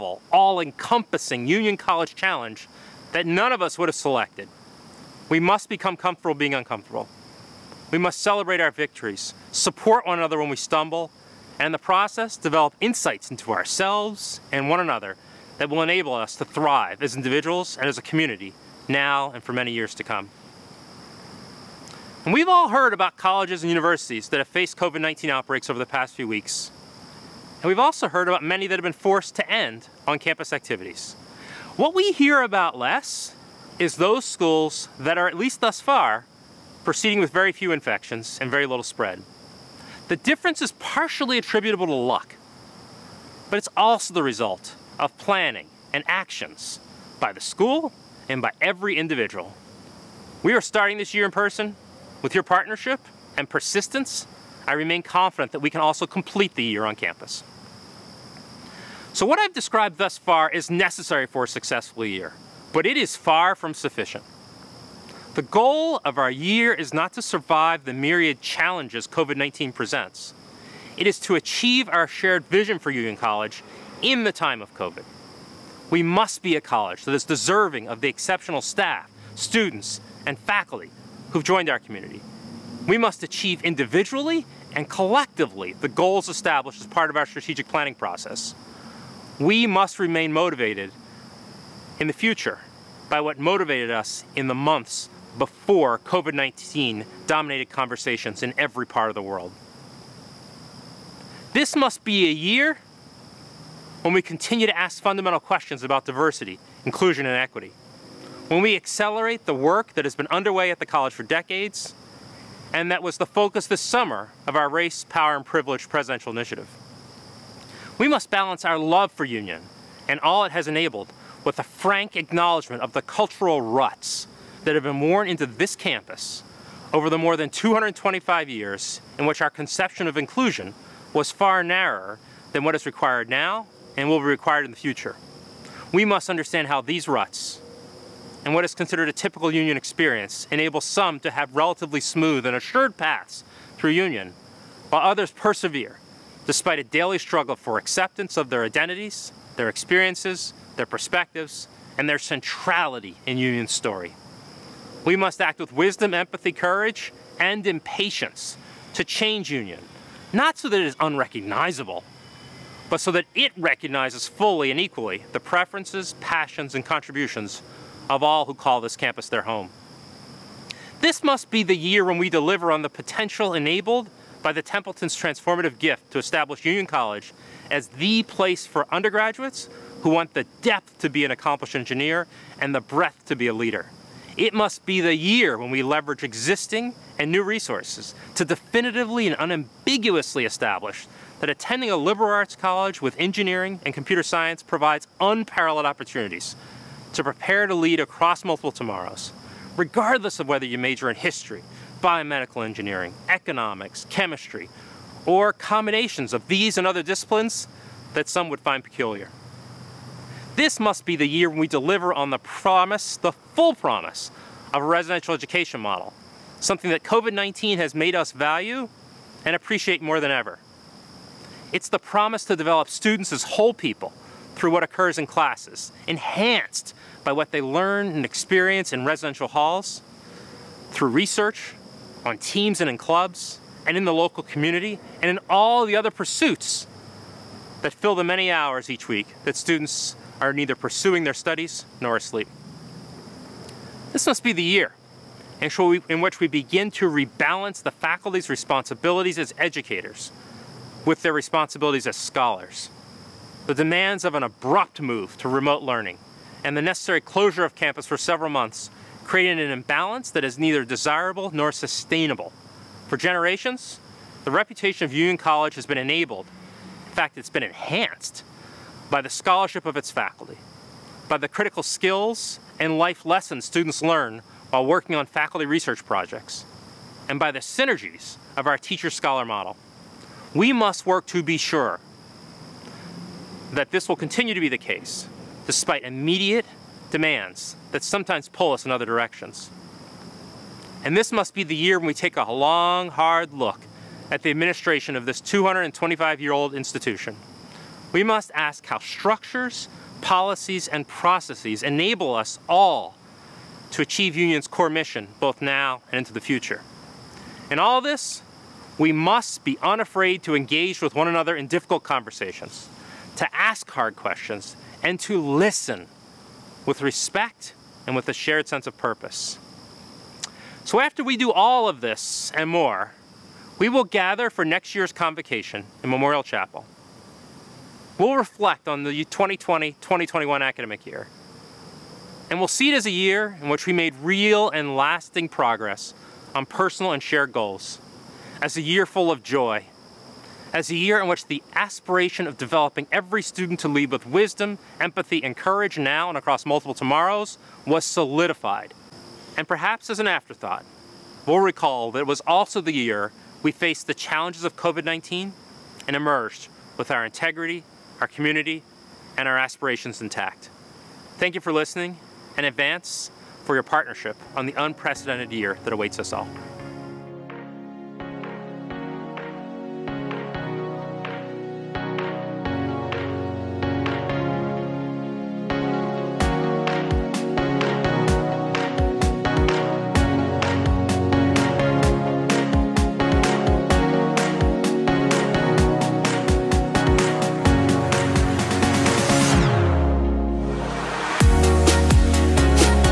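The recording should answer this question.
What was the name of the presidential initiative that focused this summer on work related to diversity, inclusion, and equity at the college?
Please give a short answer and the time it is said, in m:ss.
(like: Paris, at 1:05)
Race, Power, and Privilege, at 1:54.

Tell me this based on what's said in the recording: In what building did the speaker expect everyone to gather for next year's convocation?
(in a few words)
Memorial Chapel.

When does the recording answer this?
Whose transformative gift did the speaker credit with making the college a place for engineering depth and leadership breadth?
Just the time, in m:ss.
2:54.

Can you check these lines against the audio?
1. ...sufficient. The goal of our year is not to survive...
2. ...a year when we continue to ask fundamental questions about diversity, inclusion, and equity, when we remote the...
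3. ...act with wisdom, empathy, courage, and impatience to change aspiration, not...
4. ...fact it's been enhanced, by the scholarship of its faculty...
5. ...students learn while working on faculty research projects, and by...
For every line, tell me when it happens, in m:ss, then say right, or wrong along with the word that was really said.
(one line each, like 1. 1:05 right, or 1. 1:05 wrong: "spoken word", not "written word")
1. 1:03 right
2. 1:42 wrong: "accelerate", not "remote"
3. 2:35 wrong: "union", not "aspiration"
4. 4:27 right
5. 4:33 right.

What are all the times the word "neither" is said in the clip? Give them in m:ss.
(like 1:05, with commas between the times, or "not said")
4:00, 4:20.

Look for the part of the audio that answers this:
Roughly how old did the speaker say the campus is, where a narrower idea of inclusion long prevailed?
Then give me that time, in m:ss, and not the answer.
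2:07.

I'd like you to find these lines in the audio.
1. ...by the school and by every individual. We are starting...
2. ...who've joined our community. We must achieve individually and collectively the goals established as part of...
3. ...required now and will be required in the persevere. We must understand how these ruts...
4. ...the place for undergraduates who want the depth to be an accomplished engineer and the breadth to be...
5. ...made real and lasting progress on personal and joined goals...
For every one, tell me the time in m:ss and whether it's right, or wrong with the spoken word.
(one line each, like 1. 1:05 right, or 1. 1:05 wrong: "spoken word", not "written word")
1. 0:47 right
2. 1:21 right
3. 2:12 wrong: "future", not "persevere"
4. 2:57 right
5. 5:33 wrong: "shared", not "joined".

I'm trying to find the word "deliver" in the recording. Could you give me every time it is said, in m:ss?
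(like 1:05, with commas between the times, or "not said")
2:52, 3:31.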